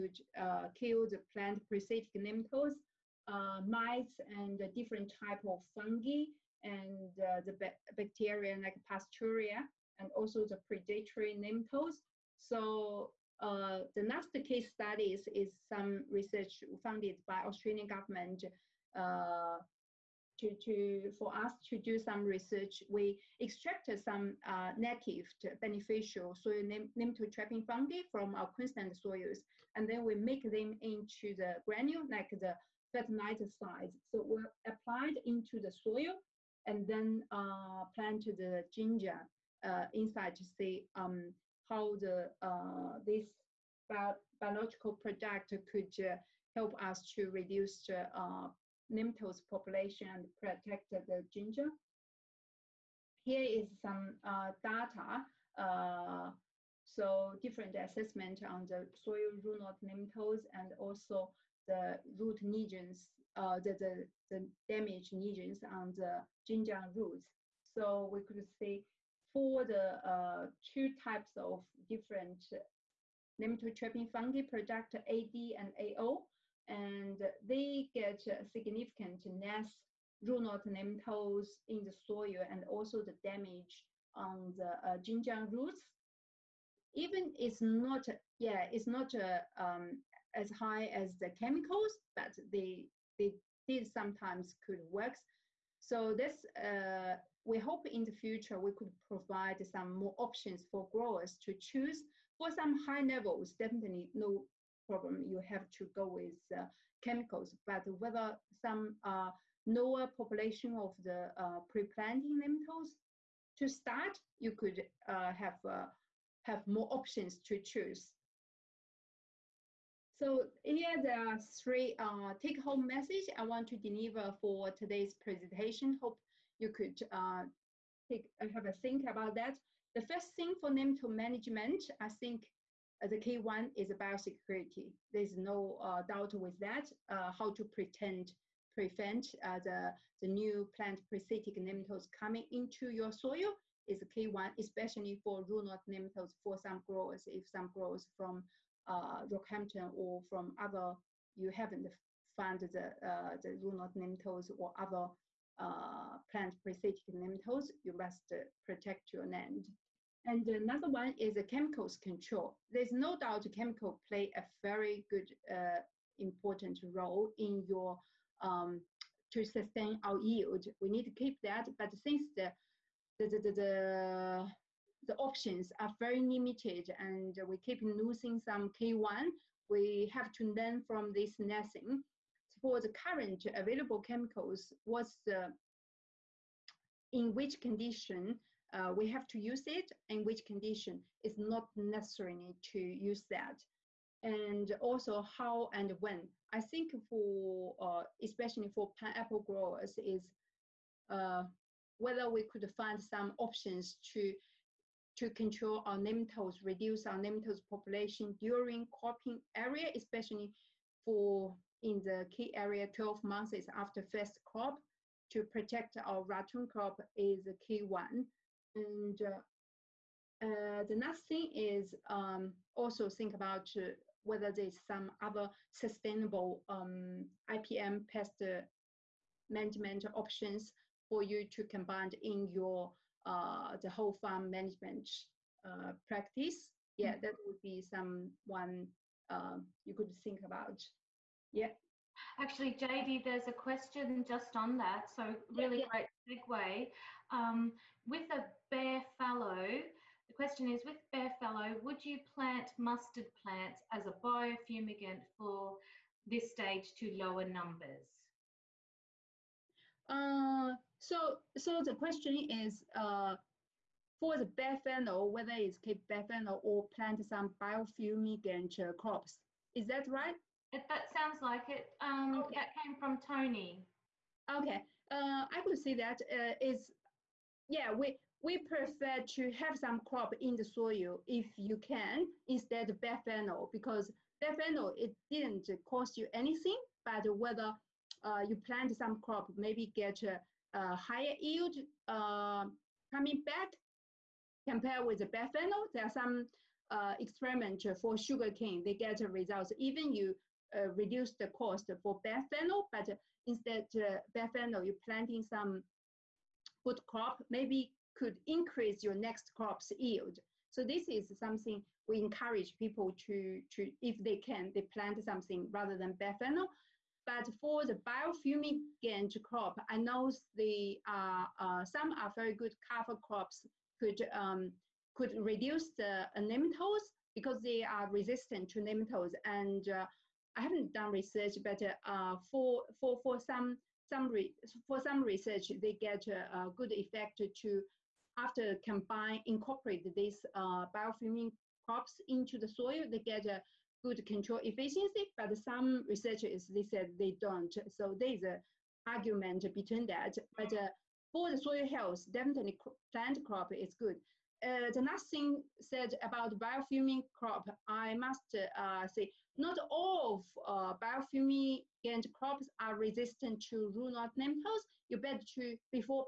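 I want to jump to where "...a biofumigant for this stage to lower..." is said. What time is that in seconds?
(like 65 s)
254 s.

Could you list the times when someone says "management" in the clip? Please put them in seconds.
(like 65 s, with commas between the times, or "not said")
131 s, 229 s, 234 s.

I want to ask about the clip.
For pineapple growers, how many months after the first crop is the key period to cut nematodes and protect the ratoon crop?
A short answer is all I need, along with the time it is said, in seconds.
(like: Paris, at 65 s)
12 months, at 212 s.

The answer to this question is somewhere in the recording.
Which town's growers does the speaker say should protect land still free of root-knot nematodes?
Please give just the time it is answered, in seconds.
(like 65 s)
149 s.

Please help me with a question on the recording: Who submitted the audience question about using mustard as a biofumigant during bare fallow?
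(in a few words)
Tony.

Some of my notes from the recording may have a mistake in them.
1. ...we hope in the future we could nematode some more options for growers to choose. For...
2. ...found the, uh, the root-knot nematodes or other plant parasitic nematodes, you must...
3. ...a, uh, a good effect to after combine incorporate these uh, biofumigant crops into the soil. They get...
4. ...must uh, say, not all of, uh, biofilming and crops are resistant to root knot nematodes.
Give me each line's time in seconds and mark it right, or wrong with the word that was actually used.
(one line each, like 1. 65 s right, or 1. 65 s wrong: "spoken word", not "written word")
1. 97 s wrong: "provide", not "nematode"
2. 152 s right
3. 336 s right
4. 358 s right.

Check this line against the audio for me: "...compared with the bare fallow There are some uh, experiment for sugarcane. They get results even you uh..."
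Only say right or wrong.
right.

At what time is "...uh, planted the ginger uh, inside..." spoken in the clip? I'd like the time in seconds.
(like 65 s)
37 s.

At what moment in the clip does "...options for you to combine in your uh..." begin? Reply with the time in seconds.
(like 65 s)
230 s.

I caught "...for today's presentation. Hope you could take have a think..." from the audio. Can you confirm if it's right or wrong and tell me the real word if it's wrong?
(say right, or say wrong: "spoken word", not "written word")
right.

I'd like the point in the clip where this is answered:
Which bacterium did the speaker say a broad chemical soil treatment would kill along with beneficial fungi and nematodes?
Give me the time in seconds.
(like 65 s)
8 s.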